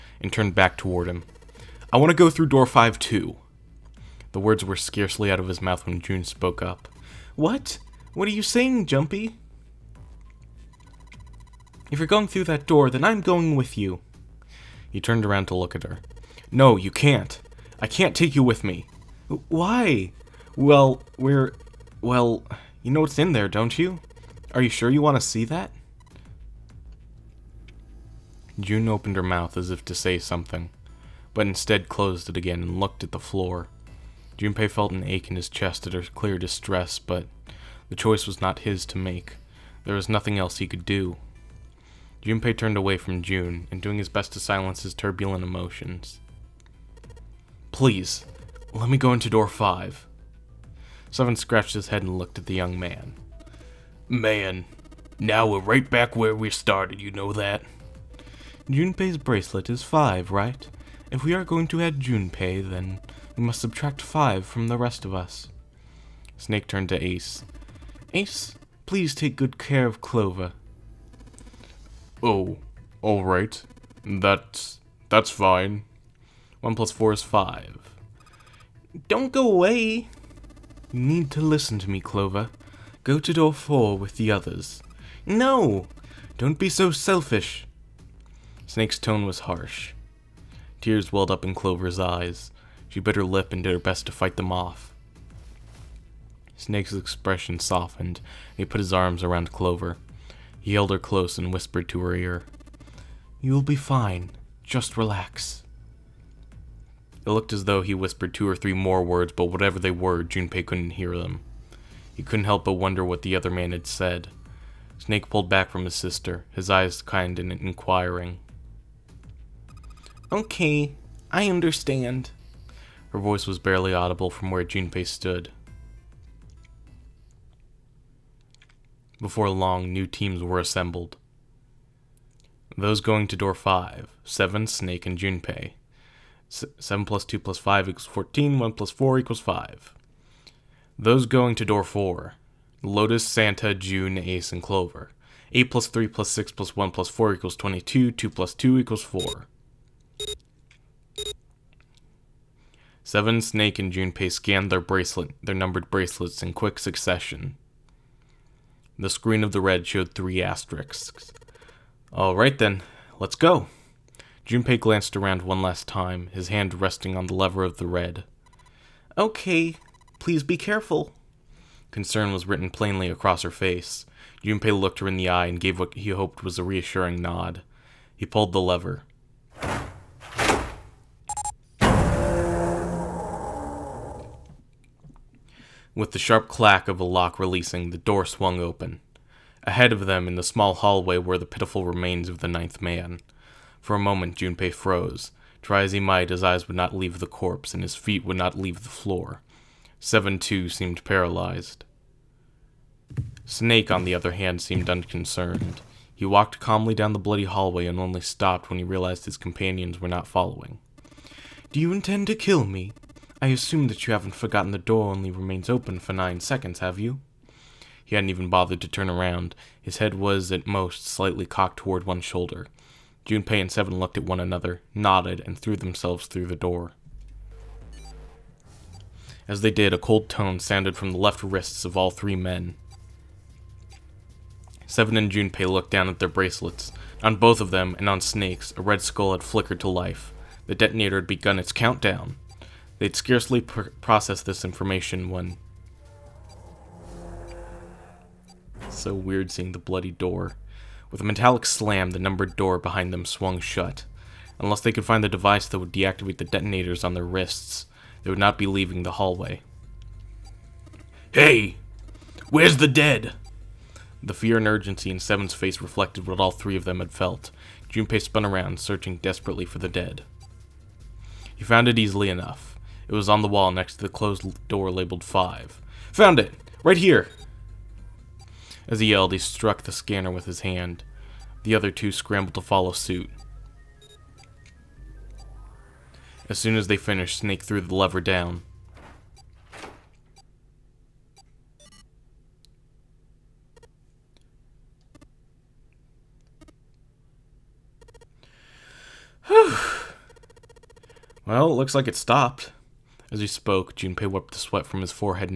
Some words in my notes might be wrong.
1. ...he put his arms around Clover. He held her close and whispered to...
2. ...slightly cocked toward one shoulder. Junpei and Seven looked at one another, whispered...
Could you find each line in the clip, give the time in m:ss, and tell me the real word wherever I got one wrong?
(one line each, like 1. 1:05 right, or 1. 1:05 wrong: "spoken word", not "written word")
1. 1:38 right
2. 3:41 wrong: "nodded", not "whispered".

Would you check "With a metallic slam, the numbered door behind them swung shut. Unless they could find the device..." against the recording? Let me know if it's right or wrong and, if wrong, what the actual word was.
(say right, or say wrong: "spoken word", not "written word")
right.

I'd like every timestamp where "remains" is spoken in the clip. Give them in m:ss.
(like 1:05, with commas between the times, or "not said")
3:11, 3:35.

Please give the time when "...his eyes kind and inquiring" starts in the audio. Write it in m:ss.
1:56.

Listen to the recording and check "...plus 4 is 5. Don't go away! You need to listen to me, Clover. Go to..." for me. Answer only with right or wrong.
right.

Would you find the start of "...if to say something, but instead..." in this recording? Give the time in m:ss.
0:29.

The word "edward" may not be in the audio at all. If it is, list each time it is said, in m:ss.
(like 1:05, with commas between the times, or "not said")
not said.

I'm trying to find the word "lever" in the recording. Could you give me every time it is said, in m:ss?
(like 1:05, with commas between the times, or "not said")
2:47, 2:58, 4:47.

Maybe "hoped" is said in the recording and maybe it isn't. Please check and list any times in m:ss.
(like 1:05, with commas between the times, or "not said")
2:56.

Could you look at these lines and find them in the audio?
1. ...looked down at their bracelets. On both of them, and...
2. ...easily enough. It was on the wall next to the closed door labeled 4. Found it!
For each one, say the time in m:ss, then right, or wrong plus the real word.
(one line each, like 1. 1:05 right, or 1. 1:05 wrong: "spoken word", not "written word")
1. 3:55 right
2. 4:31 wrong: "5", not "4".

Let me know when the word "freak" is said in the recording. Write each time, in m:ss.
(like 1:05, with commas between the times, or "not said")
not said.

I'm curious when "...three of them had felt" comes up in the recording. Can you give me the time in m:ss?
4:26.